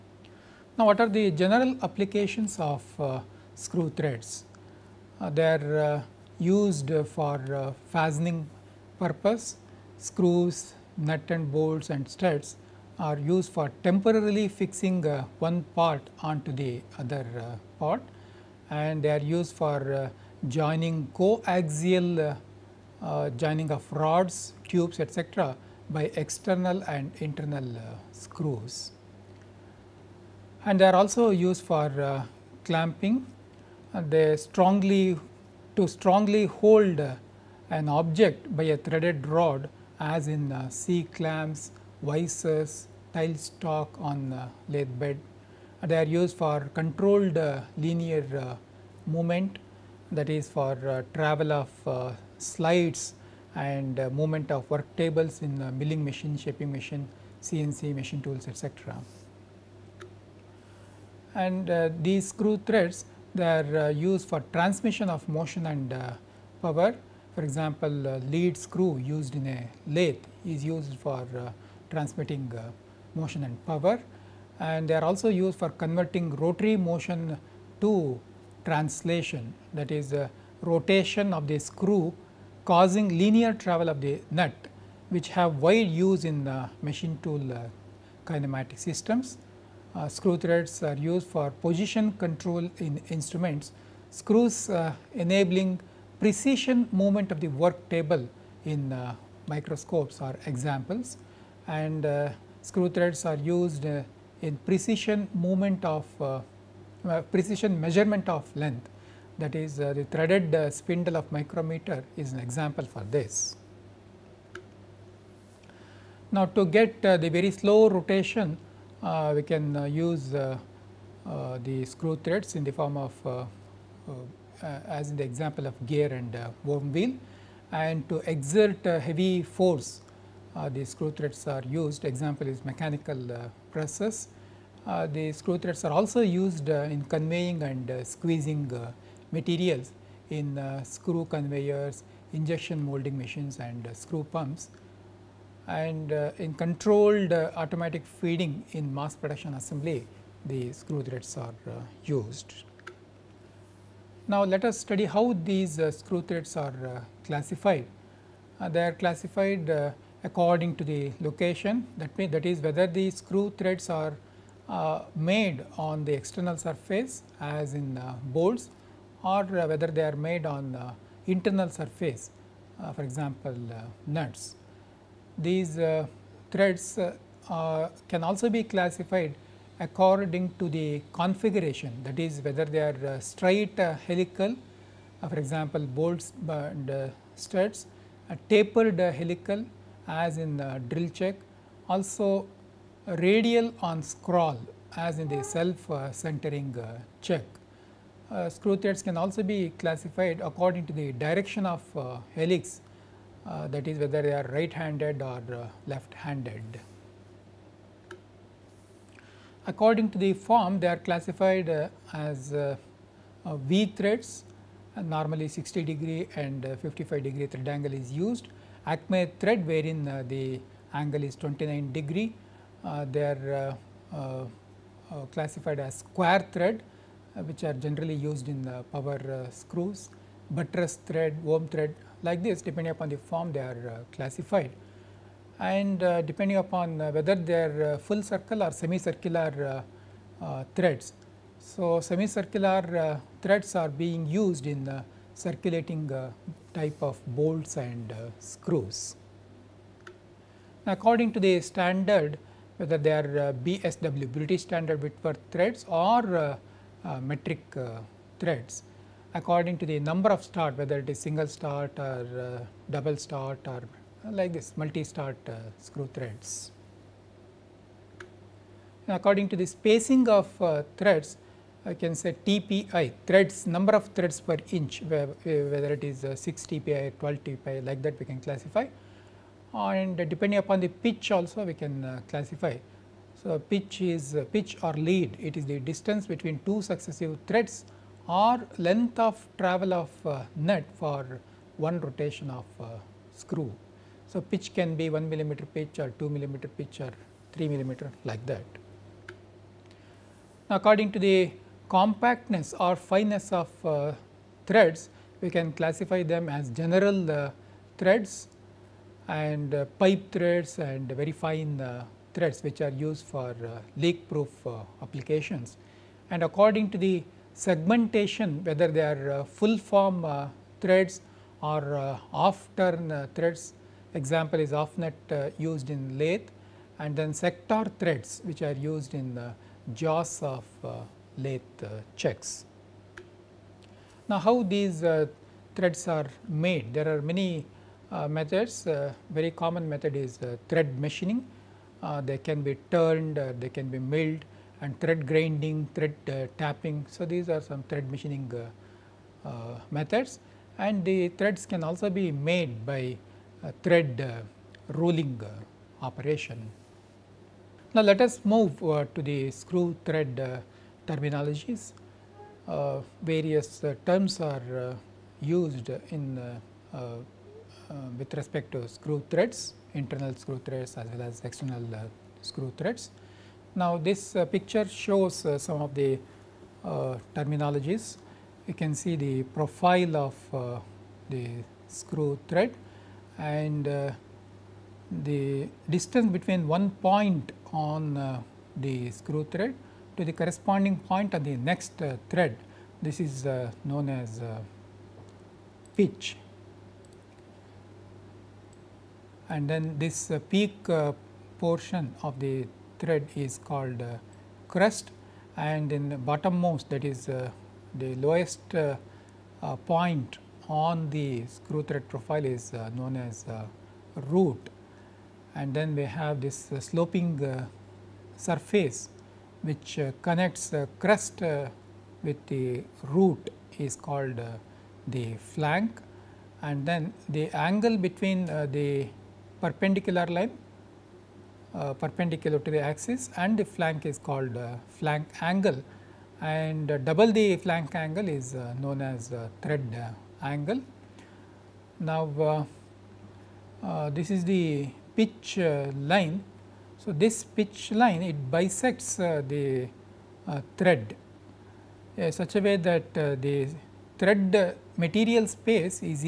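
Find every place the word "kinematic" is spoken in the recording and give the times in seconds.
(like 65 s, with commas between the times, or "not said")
88 s.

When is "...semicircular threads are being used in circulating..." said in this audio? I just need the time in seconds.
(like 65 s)
241 s.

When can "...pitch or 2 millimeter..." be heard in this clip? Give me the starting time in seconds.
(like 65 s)
295 s.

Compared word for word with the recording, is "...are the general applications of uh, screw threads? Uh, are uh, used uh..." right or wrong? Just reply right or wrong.
right.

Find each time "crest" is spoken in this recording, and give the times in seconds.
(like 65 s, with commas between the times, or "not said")
404 s, 421 s.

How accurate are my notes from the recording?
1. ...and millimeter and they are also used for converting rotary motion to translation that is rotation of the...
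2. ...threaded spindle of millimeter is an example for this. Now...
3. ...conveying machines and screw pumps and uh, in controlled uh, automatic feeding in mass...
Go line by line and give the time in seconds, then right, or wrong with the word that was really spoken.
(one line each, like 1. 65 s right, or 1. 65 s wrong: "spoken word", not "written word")
1. 73 s wrong: "power", not "millimeter"
2. 110 s wrong: "micrometer", not "millimeter"
3. 142 s wrong: "molding", not "conveying".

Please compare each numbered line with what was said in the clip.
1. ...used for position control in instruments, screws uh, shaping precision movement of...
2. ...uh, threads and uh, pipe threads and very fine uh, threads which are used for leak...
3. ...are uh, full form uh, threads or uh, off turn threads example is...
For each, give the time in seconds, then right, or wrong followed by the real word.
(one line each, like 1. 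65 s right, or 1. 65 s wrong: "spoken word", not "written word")
1. 90 s wrong: "enabling", not "shaping"
2. 307 s right
3. 319 s right.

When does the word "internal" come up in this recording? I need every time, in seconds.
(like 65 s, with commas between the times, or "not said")
27 s, 171 s, 369 s.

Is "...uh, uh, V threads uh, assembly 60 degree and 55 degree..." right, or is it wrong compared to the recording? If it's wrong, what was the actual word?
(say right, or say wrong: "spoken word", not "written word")
wrong: "normally", not "assembly".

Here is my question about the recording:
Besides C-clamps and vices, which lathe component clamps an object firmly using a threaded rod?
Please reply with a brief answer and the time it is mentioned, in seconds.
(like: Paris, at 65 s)
tail stock, at 43 s.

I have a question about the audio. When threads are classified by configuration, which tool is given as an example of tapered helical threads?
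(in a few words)
drill chuck.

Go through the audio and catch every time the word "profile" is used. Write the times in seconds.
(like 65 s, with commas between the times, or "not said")
379 s, 412 s.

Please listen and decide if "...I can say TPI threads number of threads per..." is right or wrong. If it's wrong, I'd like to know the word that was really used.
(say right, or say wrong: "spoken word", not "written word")
right.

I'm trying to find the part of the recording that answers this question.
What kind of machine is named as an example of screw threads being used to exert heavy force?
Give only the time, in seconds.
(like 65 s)
132 s.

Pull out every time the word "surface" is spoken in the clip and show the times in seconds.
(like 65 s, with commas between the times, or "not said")
166 s, 171 s, 418 s.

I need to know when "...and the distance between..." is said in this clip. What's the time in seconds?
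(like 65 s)
383 s.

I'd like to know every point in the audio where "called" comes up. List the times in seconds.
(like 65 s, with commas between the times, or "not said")
403 s, 424 s, 434 s.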